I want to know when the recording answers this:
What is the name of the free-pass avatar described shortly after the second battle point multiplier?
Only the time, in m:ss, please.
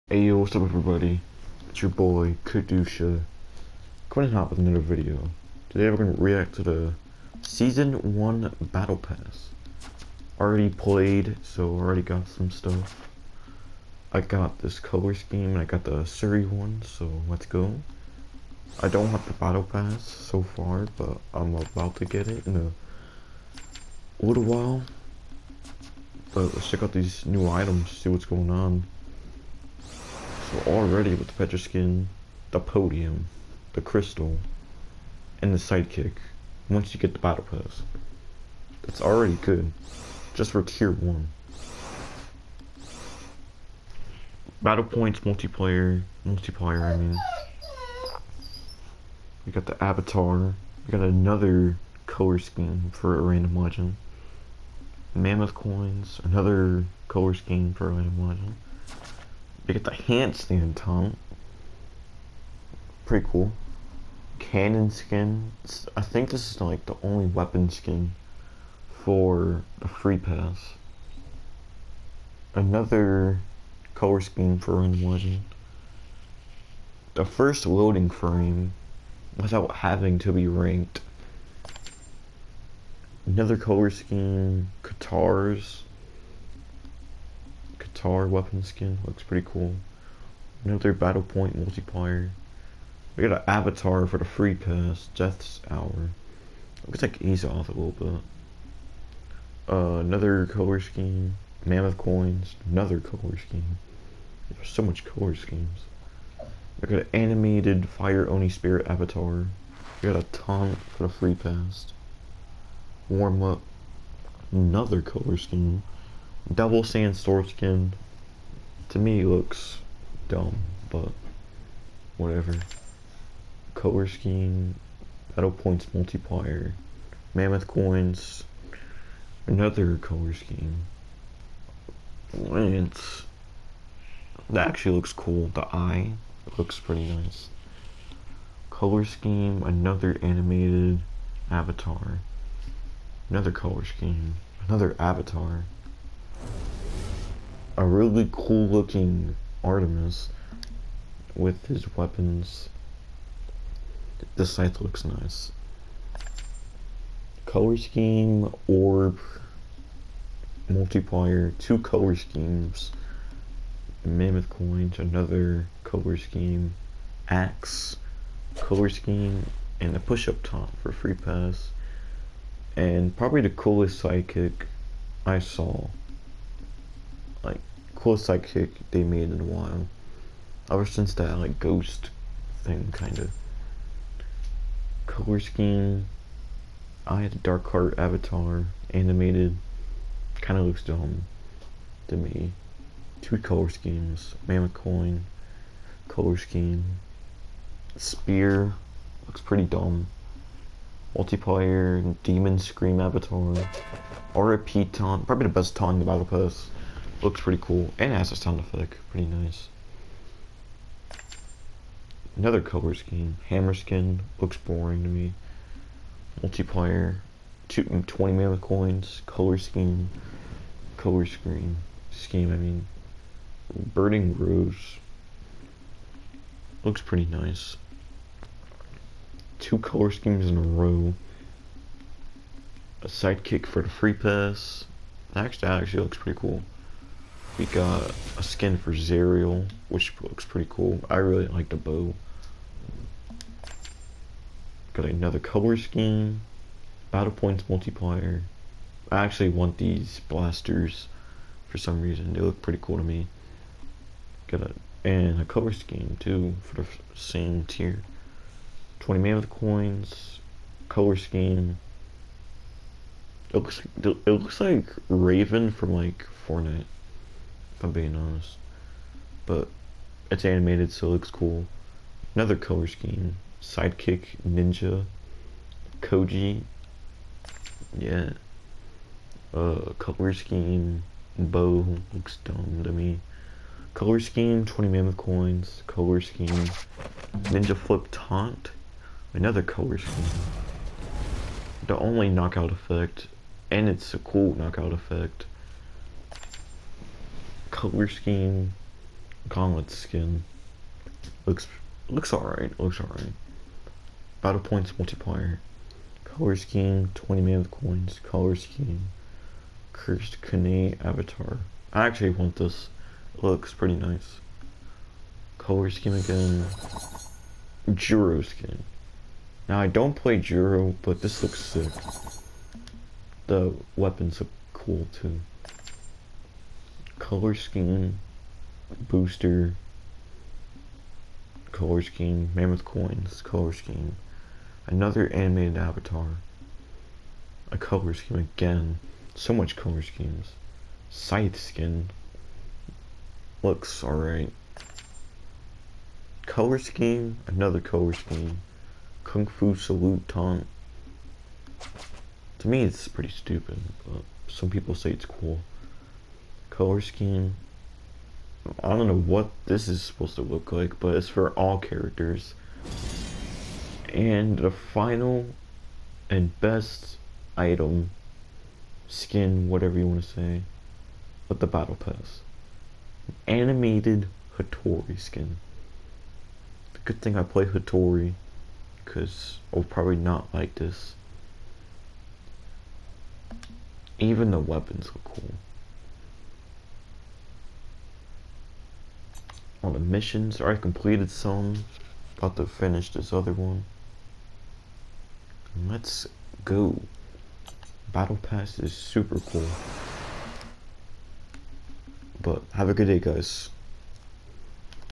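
1:35.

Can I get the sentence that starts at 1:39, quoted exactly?
Uh, another color scheme, Mammoth Coins, another color scheme.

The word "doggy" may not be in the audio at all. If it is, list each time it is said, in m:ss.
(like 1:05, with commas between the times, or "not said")
not said.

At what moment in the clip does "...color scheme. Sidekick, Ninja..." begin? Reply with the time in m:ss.
4:32.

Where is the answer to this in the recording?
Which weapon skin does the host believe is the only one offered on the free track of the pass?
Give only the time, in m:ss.
1:04.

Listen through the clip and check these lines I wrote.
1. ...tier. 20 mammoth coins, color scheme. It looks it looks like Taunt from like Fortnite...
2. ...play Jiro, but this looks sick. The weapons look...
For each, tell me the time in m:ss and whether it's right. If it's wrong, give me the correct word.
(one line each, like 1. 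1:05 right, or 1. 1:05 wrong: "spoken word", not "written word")
1. 4:17 wrong: "Raven", not "Taunt"
2. 5:20 right.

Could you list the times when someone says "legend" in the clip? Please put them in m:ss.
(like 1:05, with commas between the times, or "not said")
0:53, 0:58.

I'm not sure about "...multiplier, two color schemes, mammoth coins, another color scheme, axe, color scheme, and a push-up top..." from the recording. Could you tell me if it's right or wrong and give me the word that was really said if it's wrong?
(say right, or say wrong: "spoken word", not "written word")
right.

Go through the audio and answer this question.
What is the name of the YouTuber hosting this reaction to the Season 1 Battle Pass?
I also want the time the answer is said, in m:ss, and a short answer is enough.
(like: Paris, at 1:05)
Kxdusha, at 0:02.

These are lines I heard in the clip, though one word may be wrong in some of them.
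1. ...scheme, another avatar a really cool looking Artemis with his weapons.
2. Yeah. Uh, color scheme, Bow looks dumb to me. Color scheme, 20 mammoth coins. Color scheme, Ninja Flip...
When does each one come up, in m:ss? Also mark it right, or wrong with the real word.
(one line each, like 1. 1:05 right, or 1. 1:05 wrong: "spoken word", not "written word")
1. 2:23 right
2. 4:37 right.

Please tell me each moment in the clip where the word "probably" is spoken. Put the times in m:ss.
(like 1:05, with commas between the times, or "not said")
2:53, 3:25, 6:19.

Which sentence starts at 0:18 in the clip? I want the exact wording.
I don't have the Battle Pass so far, but I'm about to get it in a little while.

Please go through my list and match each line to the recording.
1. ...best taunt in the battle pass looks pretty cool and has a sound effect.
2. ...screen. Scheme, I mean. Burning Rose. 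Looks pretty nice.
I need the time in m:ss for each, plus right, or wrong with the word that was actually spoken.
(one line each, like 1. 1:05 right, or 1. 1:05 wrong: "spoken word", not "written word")
1. 3:25 right
2. 3:41 right.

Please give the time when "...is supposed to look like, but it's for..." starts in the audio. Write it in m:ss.
5:59.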